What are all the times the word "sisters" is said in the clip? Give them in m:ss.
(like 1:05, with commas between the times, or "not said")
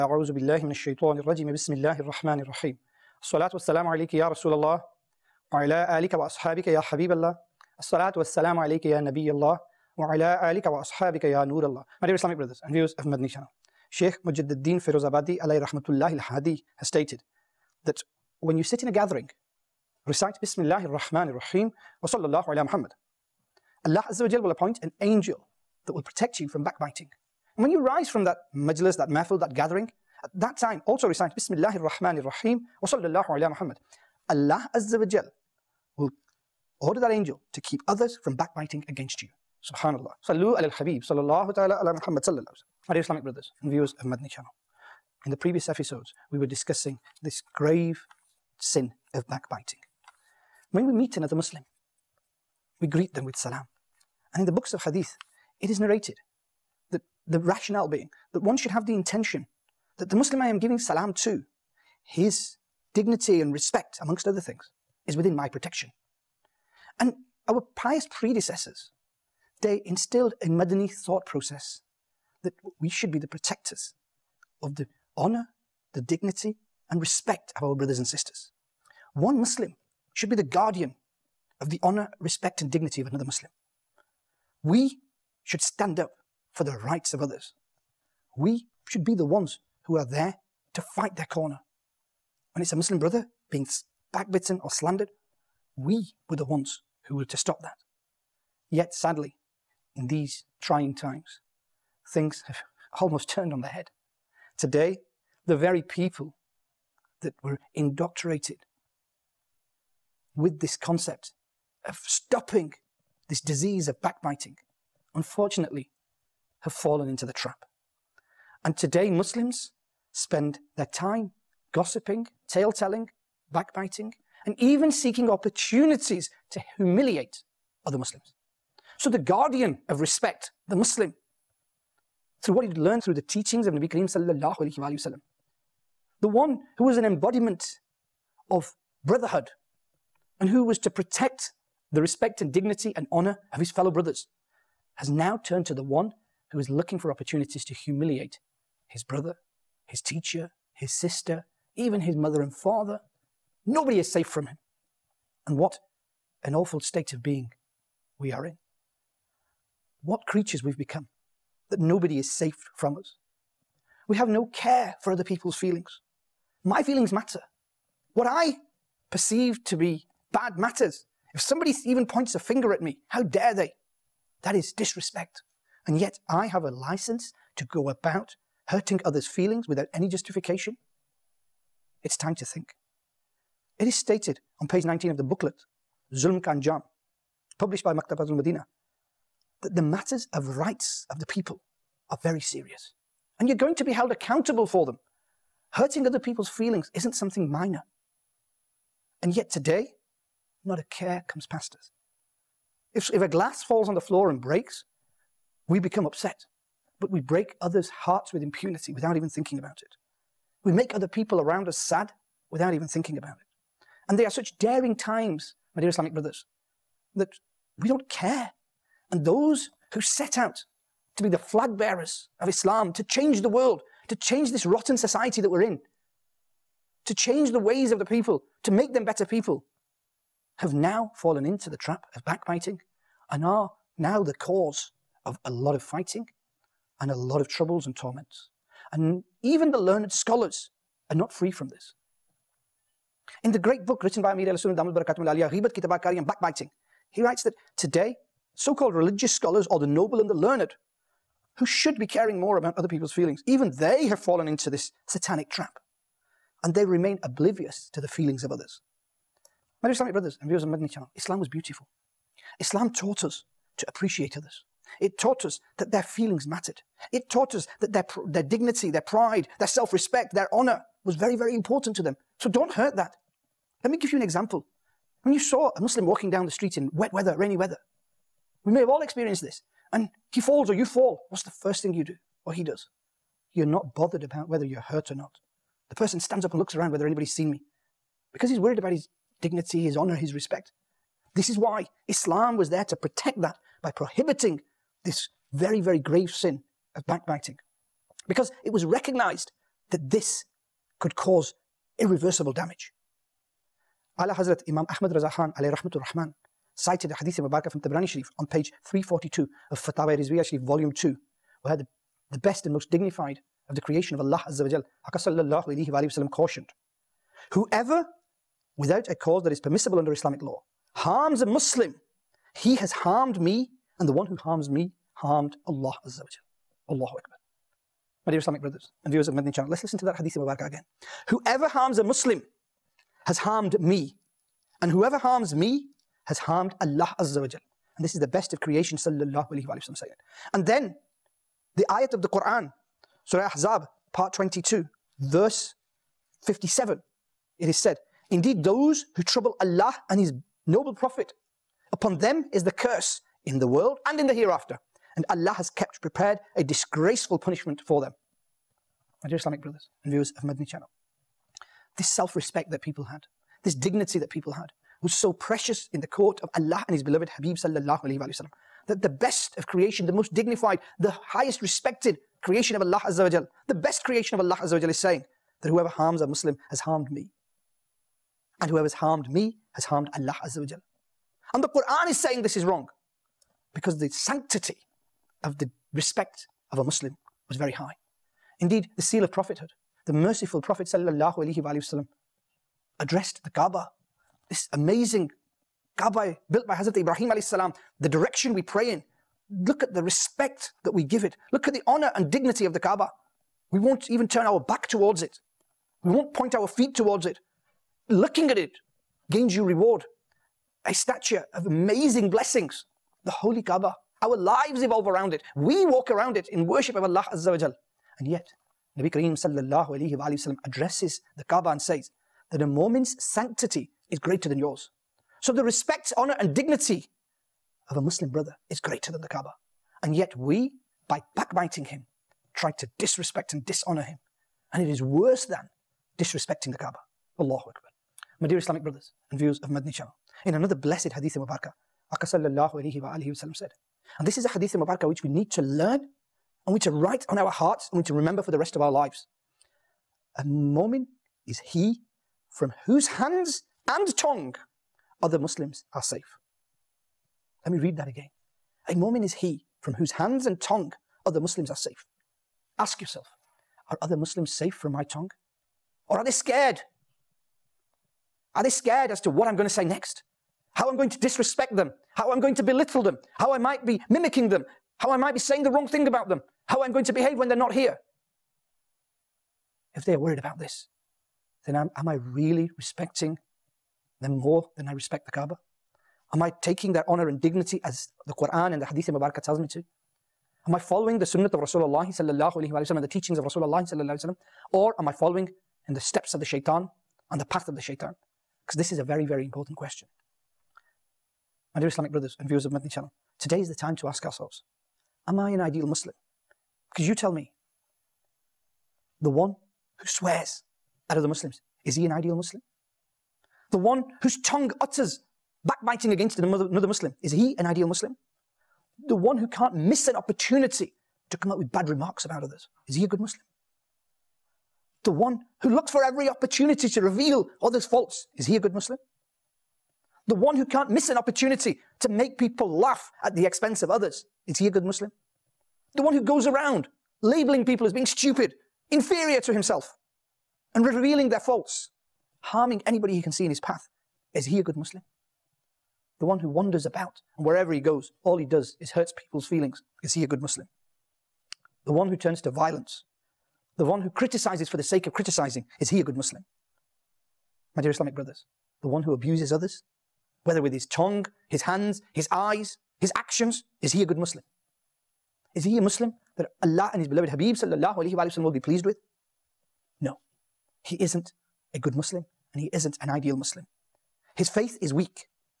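1:18, 2:30.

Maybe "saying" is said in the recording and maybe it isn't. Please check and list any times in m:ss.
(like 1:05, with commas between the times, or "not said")
5:39, 6:14, 6:22, 7:55.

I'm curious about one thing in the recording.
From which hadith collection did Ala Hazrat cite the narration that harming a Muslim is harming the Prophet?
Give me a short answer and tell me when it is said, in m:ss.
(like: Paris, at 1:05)
Tabrani Sharif, at 5:07.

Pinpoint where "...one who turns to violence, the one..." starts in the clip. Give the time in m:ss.
9:11.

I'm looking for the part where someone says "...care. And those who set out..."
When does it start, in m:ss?
3:38.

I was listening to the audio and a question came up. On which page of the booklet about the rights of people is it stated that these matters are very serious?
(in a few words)
19.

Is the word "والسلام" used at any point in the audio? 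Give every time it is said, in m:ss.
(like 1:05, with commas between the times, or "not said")
0:03, 0:08.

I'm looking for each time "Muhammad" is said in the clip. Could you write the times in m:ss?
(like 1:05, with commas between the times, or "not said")
0:22, 0:33, 0:41.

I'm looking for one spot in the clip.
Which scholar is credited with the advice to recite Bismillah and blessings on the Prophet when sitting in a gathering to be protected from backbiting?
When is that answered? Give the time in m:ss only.
0:13.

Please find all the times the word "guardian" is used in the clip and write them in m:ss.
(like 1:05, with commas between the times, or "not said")
1:20, 2:09.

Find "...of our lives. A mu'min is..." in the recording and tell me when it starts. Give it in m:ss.
7:28.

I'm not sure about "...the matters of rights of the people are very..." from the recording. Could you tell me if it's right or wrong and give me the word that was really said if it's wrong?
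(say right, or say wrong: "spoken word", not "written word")
right.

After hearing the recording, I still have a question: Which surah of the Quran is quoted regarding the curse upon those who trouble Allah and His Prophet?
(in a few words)
Surah Ahzab.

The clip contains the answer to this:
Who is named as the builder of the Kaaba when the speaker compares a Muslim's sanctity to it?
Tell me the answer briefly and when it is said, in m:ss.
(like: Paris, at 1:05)
Hazrat Ibrahim, at 6:36.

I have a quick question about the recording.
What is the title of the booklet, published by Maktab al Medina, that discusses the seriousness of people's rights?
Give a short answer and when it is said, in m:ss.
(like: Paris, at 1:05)
Zulm Jam, at 3:06.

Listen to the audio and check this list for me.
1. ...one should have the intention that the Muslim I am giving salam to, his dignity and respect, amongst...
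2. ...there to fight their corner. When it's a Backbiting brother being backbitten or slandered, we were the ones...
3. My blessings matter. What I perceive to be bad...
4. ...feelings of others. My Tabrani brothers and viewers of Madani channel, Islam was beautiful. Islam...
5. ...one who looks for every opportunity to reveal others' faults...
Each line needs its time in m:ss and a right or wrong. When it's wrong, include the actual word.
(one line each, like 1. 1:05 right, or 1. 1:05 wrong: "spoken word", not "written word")
1. 0:58 right
2. 1:30 wrong: "Muslim", not "Backbiting"
3. 2:46 wrong: "feelings", not "blessings"
4. 4:18 wrong: "Islamic", not "Tabrani"
5. 8:45 right.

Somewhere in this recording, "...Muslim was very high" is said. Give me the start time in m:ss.
6:26.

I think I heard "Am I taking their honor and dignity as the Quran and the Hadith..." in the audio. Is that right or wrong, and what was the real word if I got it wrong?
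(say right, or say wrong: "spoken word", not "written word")
right.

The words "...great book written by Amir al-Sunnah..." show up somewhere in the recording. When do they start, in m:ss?
4:03.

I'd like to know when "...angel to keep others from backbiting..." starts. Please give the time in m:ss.
0:37.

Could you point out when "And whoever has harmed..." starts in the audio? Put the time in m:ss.
6:18.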